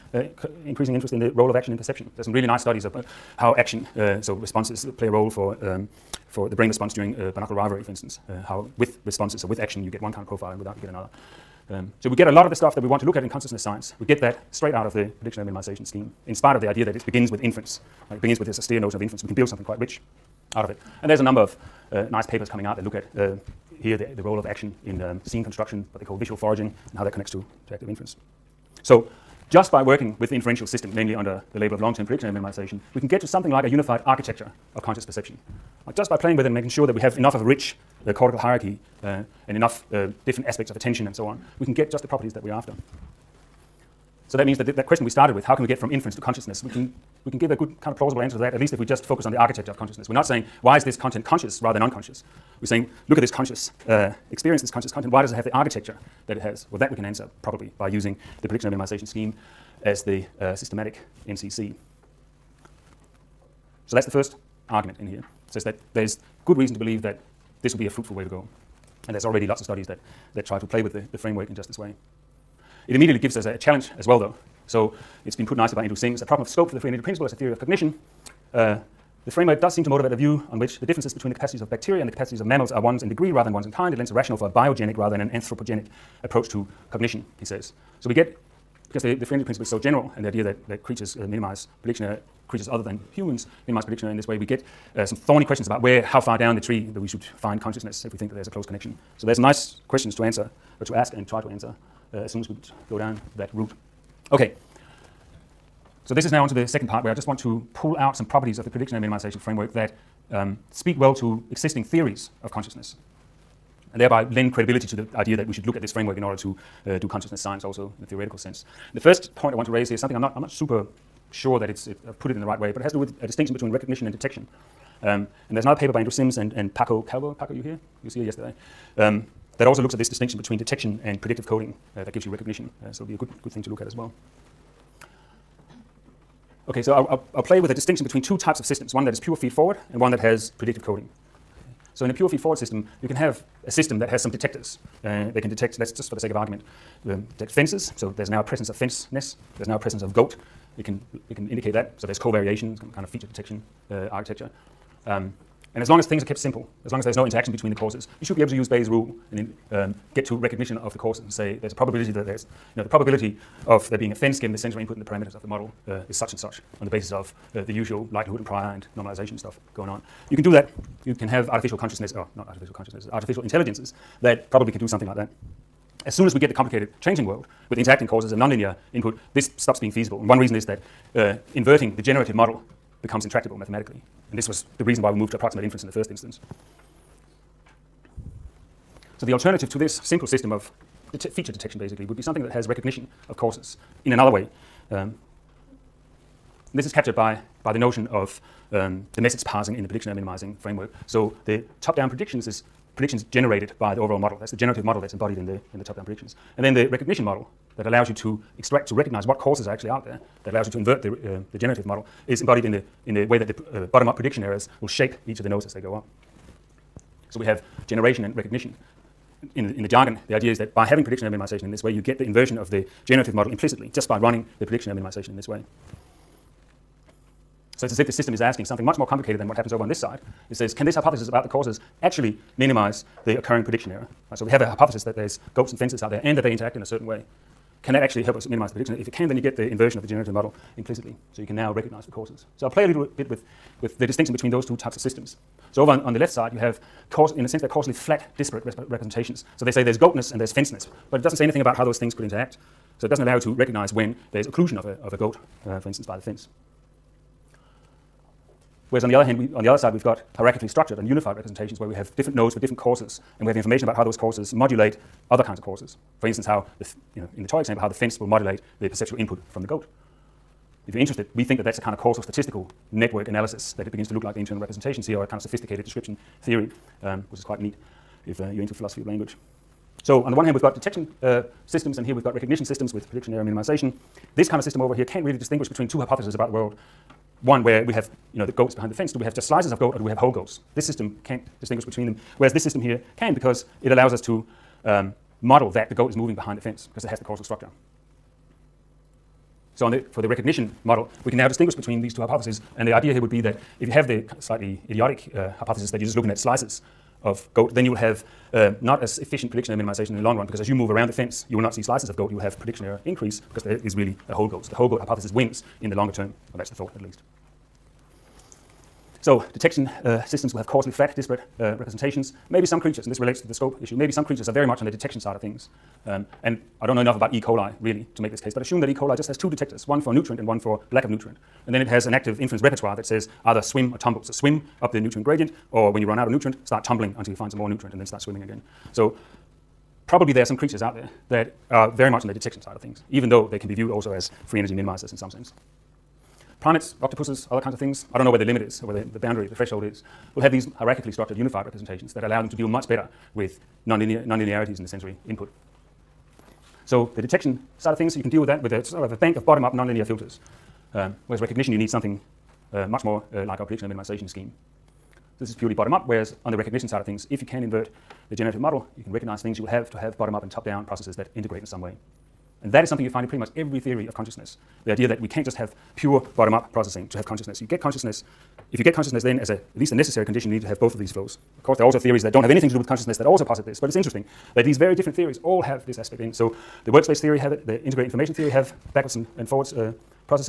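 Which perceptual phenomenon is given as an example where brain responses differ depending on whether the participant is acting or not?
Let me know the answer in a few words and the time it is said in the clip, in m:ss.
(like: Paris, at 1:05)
binocular rivalry, at 0:07.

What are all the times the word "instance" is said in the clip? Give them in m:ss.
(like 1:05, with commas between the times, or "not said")
0:07, 3:06, 4:15, 4:26.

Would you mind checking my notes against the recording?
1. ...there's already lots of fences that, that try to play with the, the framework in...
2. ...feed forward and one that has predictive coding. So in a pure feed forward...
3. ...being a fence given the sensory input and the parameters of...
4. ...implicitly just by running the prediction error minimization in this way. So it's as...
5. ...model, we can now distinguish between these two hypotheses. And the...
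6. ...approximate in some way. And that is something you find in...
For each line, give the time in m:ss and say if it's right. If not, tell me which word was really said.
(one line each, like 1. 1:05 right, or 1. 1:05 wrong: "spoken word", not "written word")
1. 1:09 wrong: "studies", not "fences"
2. 2:19 right
3. 2:43 right
4. 3:43 right
5. 5:00 right
6. 6:11 wrong: "integrate", not "approximate".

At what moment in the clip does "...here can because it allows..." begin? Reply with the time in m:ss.
4:52.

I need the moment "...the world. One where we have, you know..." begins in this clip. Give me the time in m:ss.
4:46.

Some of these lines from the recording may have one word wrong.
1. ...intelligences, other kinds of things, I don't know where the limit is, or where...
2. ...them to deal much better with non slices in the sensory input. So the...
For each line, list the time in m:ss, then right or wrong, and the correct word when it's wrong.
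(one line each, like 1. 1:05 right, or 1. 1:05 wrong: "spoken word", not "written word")
1. 5:47 wrong: "octopuses", not "intelligences"
2. 5:52 wrong: "nonlinearities", not "slices".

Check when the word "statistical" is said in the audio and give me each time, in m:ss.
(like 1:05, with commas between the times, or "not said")
4:32.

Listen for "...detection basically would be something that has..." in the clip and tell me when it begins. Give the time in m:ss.
3:11.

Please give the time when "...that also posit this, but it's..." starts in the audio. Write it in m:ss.
6:23.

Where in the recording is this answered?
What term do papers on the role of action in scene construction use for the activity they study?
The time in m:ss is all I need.
0:26.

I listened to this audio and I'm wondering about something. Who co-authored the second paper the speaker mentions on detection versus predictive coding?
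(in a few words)
Paco Calvo.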